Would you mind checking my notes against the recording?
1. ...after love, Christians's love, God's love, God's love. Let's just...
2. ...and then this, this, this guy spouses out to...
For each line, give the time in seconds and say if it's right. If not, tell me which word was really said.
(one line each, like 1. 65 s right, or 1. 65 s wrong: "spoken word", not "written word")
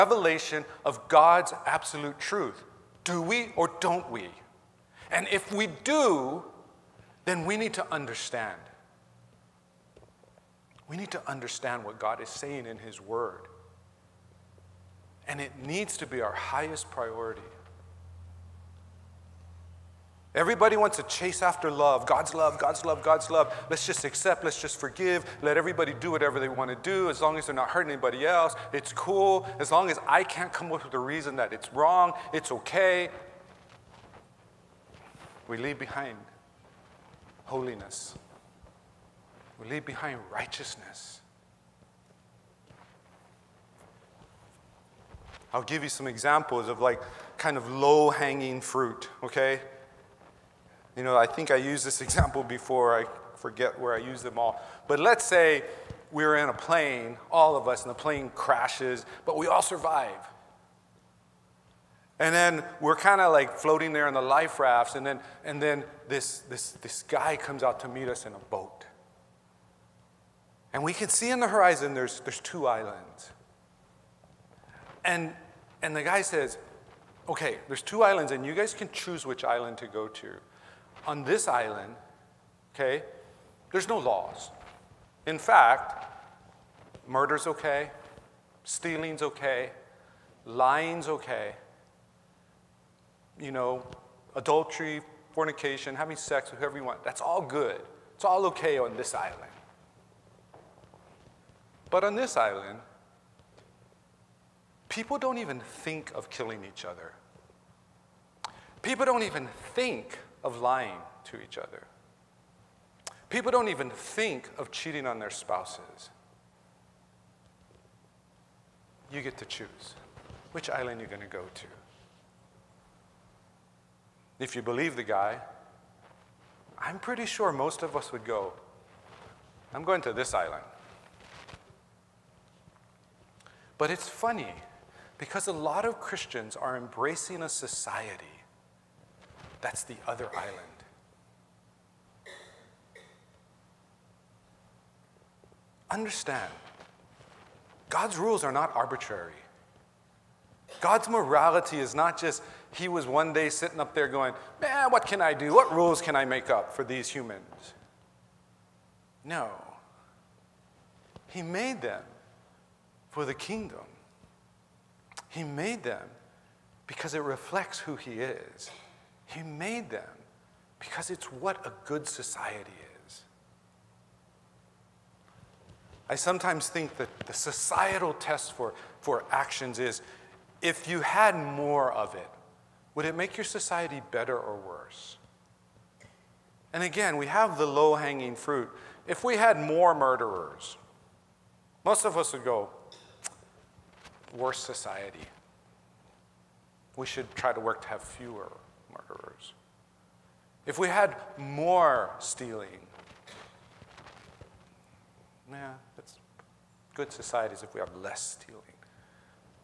1. 21 s wrong: "God", not "Christians"
2. 65 s wrong: "comes", not "spouses".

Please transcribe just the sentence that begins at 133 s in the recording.
But it's funny because a lot of Christians are embracing a society that's the other island.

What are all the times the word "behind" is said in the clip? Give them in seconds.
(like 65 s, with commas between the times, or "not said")
35 s, 39 s.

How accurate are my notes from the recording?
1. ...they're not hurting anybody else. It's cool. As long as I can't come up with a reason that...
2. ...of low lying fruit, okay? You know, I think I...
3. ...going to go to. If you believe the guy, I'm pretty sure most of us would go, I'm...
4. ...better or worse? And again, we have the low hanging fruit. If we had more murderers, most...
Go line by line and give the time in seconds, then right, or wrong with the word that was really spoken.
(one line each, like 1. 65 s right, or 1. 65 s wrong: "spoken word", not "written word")
1. 27 s right
2. 47 s wrong: "hanging", not "lying"
3. 121 s right
4. 184 s right.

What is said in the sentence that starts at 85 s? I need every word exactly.
In fact, murder's okay, stealing's okay, lying's okay, you know, adultery, fornication, having sex with whoever you want, that's all good.